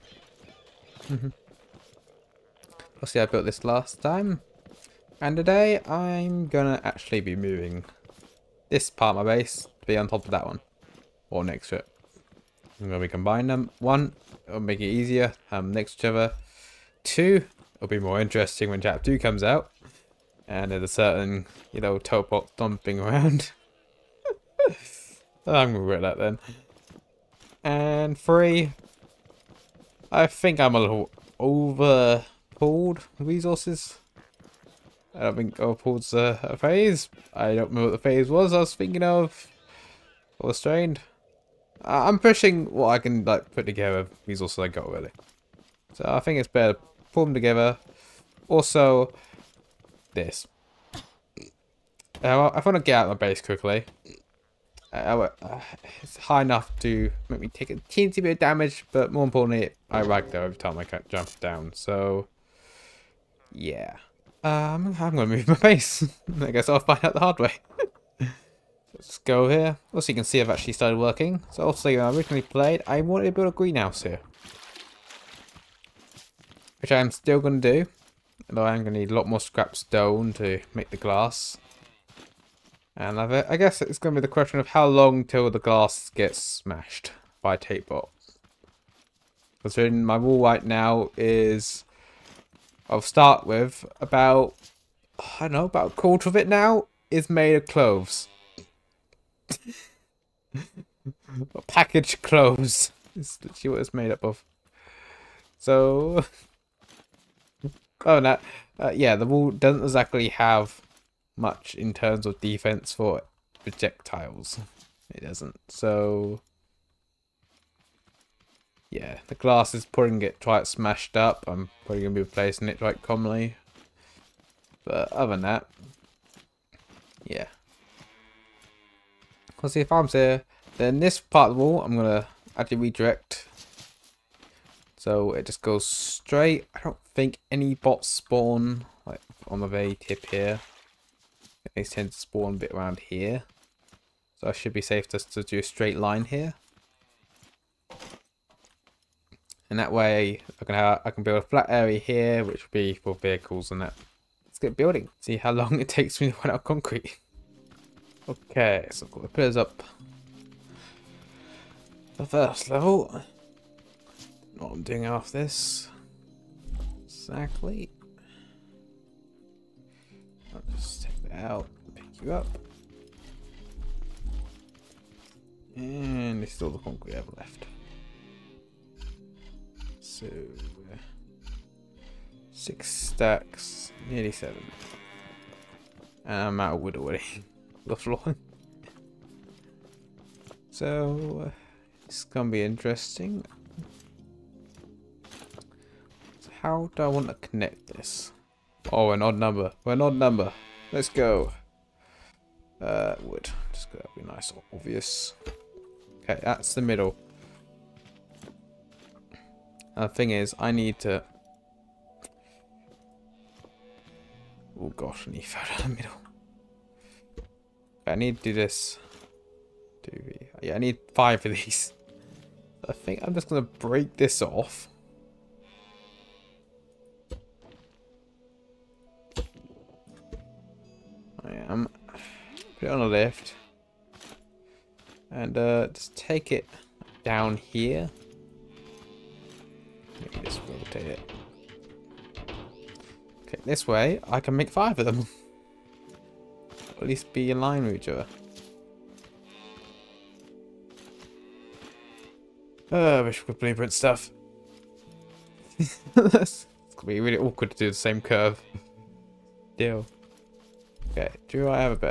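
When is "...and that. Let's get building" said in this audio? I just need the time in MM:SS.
02:33.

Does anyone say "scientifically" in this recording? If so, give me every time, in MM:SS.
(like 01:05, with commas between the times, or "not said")
not said.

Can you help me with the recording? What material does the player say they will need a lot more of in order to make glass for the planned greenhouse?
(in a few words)
Scrap stone.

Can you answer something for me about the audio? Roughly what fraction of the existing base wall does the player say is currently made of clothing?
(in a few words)
A quarter.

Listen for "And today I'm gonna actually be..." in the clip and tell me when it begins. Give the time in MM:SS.
00:05.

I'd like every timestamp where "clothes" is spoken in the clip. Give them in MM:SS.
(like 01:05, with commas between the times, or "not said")
01:37, 01:42.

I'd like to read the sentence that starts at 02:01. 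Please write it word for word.
I'm probably going to be replacing it quite commonly.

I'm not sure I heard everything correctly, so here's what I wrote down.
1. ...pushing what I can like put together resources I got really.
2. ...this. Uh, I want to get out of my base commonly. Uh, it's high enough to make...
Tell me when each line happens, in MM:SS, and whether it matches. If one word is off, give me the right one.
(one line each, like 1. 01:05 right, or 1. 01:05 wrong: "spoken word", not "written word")
1. 00:42 right
2. 00:50 wrong: "quickly", not "commonly".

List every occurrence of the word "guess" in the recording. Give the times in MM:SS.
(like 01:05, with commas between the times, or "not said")
01:06, 01:23.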